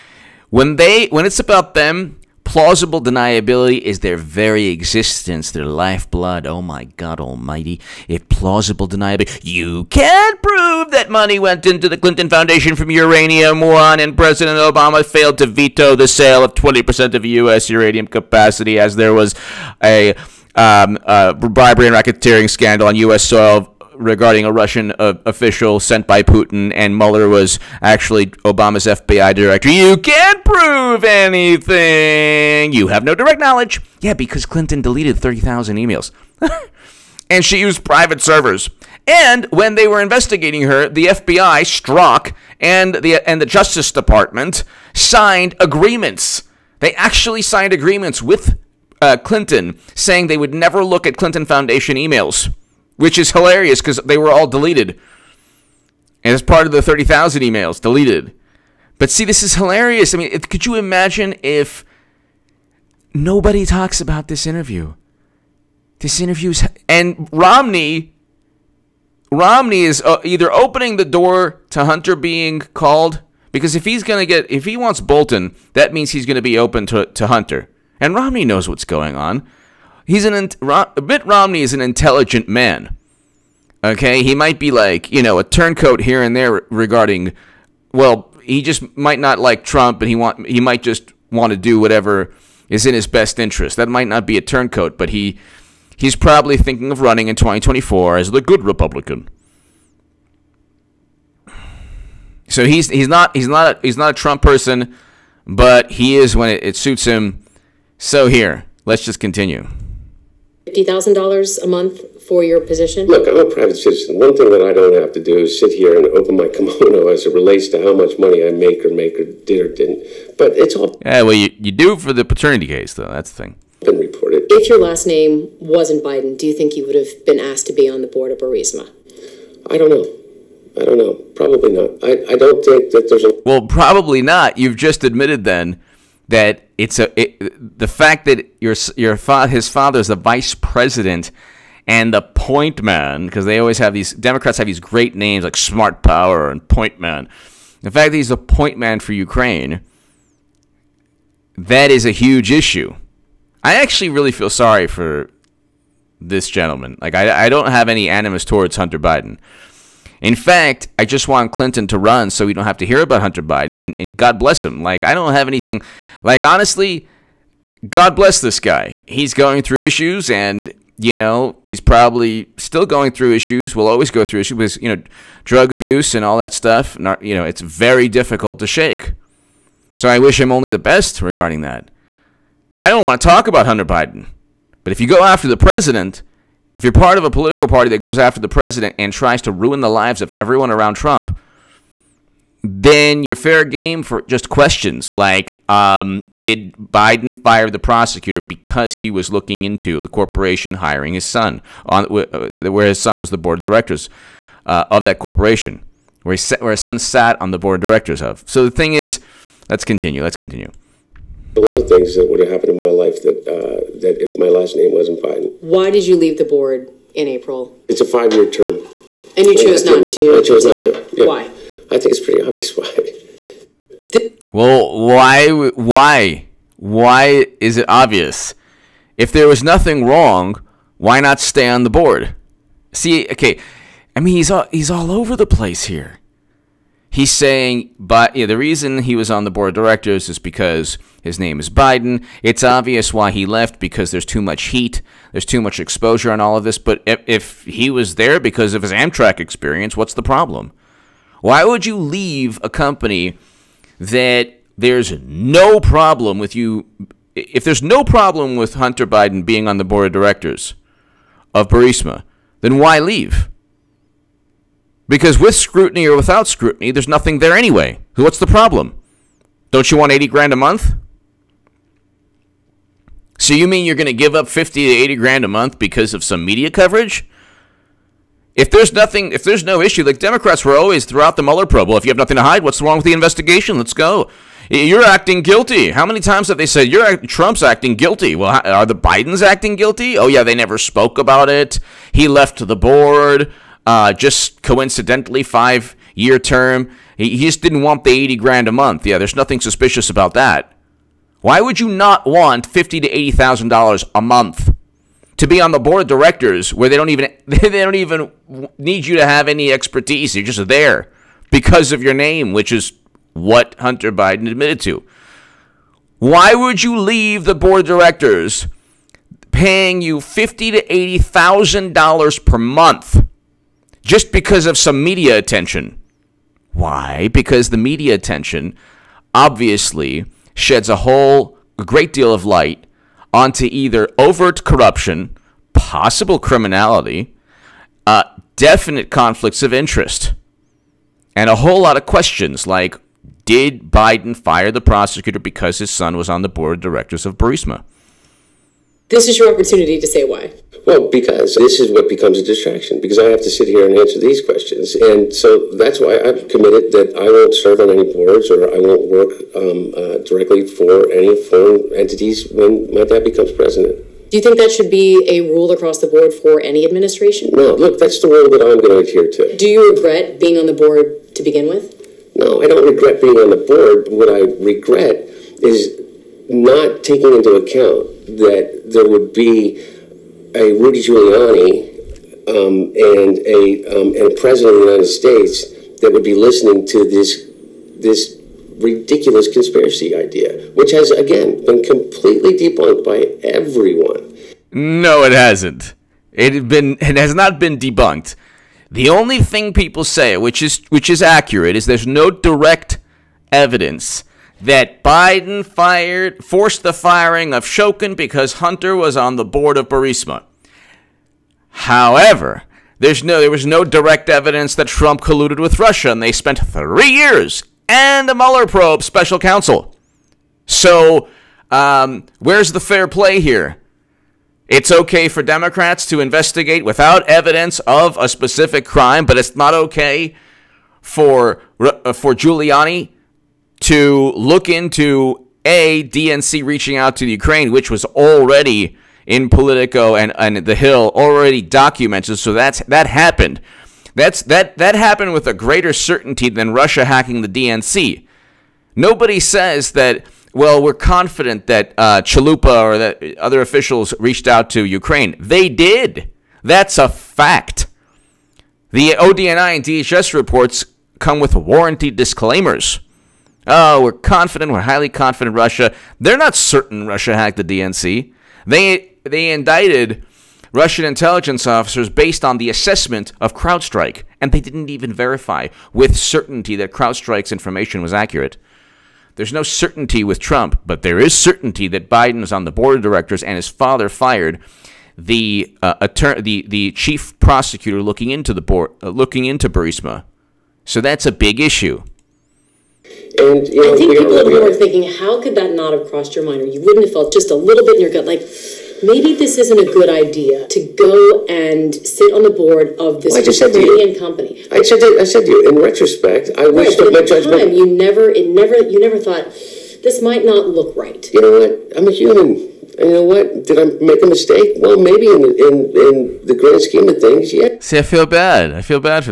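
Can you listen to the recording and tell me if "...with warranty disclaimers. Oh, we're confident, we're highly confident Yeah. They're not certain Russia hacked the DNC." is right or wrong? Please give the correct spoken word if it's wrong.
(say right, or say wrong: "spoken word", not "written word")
wrong: "Russia", not "Yeah".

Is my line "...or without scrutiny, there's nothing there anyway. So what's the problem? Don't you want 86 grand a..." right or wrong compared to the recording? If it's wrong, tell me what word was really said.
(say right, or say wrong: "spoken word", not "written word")
wrong: "80", not "86".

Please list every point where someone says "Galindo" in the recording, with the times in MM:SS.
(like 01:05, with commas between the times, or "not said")
not said.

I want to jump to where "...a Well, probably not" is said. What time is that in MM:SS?
02:13.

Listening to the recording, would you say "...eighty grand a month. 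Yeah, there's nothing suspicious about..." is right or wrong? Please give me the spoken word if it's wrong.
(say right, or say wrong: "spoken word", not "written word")
right.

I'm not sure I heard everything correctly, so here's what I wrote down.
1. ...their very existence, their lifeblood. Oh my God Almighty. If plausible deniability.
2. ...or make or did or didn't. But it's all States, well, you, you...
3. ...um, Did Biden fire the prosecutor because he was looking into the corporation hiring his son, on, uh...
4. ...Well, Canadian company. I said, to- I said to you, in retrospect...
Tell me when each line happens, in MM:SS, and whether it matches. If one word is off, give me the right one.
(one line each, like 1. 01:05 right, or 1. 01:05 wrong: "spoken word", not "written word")
1. 00:04 right
2. 01:58 wrong: "Yeah", not "States"
3. 03:15 right
4. 08:23 right.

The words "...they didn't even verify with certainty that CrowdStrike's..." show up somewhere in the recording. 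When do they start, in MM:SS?
07:54.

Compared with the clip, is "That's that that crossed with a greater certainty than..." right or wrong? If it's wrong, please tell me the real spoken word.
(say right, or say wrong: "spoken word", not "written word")
wrong: "happened", not "crossed".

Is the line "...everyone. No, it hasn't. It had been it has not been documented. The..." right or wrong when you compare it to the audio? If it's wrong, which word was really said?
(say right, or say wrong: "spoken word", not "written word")
wrong: "debunked", not "documented".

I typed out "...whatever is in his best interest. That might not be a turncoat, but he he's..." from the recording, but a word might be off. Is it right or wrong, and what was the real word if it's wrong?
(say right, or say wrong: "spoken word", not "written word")
right.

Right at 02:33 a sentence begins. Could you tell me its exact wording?
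I actually really feel sorry for this gentleman.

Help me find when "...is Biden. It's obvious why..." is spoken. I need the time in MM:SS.
04:01.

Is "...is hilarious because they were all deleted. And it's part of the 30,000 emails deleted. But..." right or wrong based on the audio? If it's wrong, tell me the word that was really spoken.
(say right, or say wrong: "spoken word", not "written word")
right.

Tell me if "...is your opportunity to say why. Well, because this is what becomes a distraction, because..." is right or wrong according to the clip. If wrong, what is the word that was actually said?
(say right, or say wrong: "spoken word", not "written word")
right.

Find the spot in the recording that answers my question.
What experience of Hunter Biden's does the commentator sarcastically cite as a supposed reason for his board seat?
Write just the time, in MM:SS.
04:08.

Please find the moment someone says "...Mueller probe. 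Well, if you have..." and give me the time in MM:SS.
04:41.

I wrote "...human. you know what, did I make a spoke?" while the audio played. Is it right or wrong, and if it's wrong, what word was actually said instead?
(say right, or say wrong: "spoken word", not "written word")
wrong: "mistake", not "spoke".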